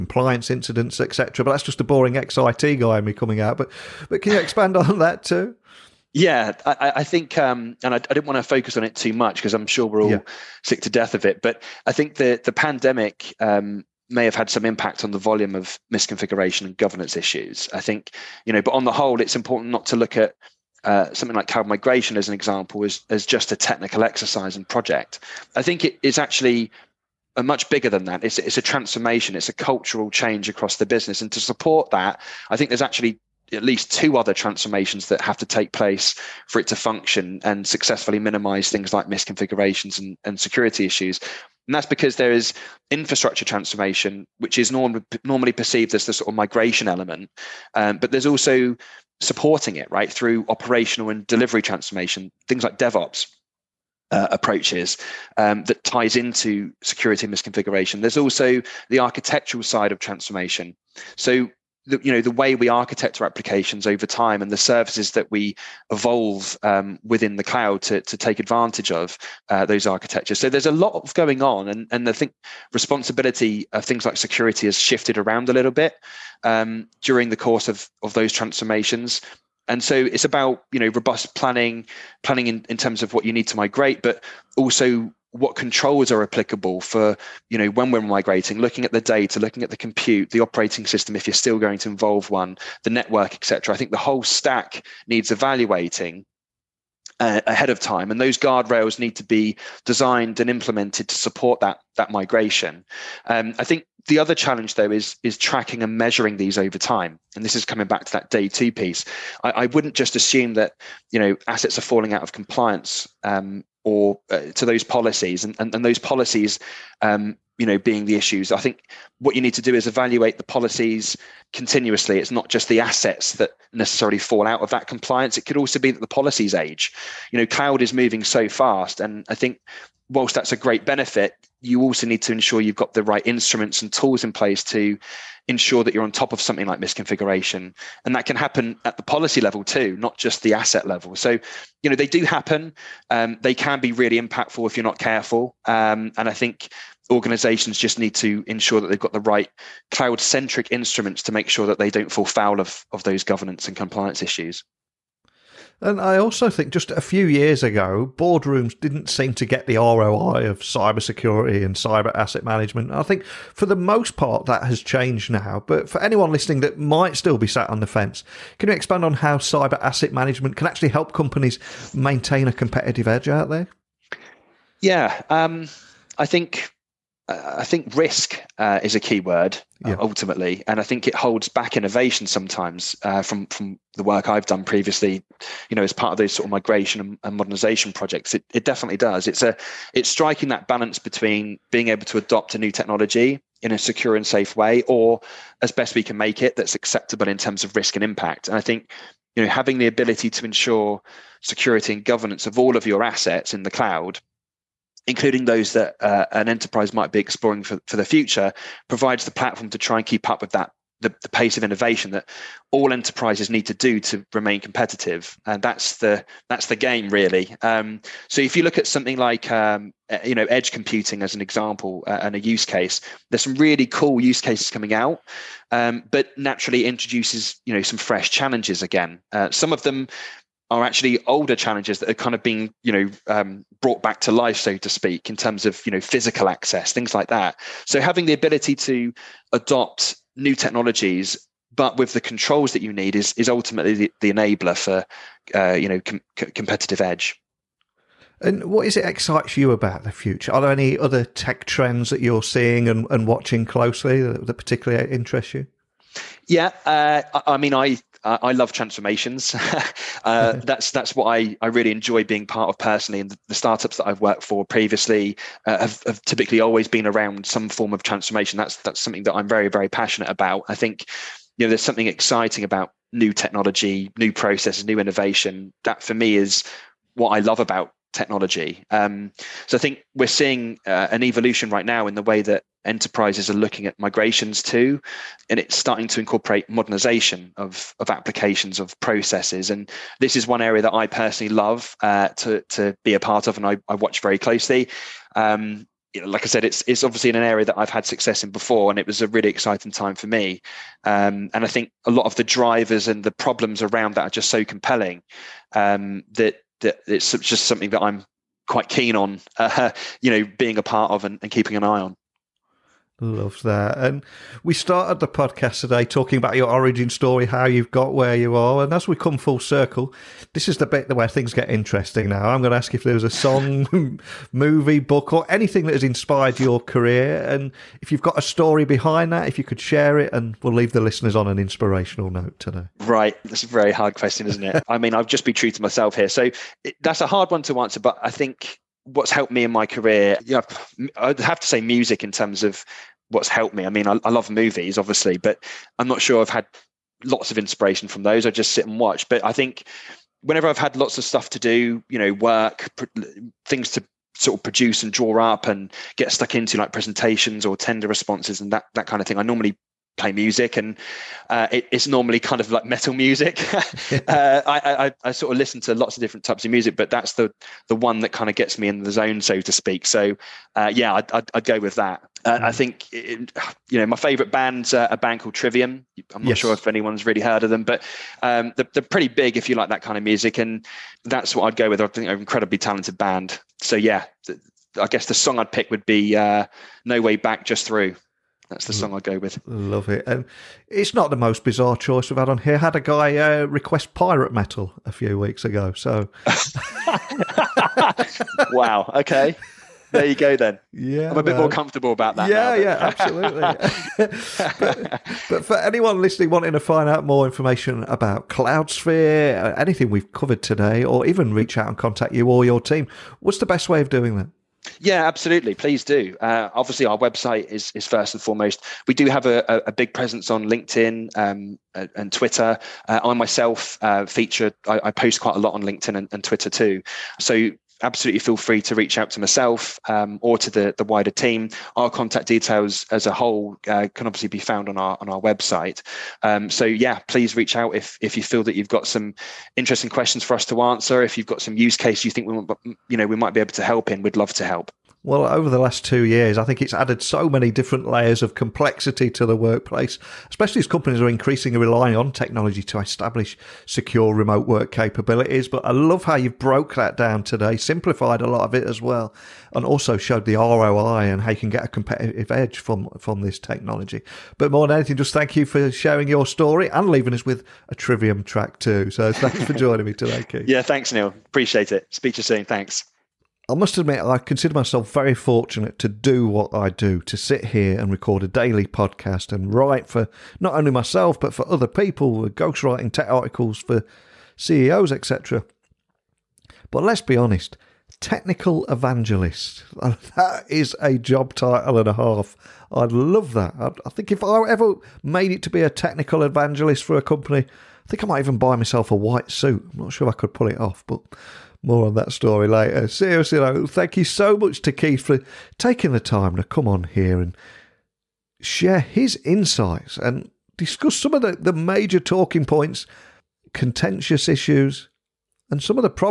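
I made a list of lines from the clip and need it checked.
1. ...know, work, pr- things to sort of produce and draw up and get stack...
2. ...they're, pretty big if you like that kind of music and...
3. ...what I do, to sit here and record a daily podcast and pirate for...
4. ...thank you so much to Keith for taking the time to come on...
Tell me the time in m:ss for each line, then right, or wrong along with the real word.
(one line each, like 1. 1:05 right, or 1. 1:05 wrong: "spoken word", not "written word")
1. 5:52 wrong: "stuck", not "stack"
2. 6:18 right
3. 7:56 wrong: "write", not "pirate"
4. 8:23 right.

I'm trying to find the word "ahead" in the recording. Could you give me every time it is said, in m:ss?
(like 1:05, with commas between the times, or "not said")
1:37.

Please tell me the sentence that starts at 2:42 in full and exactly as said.
I think for the most part that has changed now.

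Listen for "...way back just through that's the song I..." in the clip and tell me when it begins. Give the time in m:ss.
6:27.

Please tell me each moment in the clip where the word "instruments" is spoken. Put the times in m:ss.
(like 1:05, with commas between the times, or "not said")
2:13, 2:30.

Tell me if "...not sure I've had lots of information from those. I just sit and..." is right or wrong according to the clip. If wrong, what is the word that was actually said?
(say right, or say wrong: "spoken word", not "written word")
wrong: "inspiration", not "information".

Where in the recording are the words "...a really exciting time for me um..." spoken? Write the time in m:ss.
4:59.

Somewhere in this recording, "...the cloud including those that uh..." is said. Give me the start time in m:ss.
3:23.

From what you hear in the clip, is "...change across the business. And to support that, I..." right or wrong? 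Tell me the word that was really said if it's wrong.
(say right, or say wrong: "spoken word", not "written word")
right.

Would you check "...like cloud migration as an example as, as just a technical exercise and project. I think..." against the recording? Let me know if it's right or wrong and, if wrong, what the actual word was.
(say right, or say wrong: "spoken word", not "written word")
right.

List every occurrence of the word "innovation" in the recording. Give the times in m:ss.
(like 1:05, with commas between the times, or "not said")
3:01, 3:31, 4:34.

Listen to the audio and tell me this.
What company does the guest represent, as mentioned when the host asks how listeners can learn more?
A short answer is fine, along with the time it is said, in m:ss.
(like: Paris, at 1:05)
Cloudsphere, at 6:48.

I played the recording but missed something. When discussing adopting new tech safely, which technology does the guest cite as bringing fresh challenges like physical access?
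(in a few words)
edge computing.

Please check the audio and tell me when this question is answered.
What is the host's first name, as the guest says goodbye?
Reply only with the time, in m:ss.
7:51.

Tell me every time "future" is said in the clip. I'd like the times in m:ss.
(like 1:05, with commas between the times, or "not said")
3:28, 4:10.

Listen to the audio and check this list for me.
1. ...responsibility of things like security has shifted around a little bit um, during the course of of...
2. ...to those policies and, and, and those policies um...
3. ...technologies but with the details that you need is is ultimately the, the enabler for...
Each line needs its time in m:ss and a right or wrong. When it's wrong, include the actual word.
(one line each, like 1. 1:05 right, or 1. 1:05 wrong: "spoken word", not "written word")
1. 1:12 right
2. 1:54 right
3. 4:00 wrong: "controls", not "details".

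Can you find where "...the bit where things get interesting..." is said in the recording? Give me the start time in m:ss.
5:20.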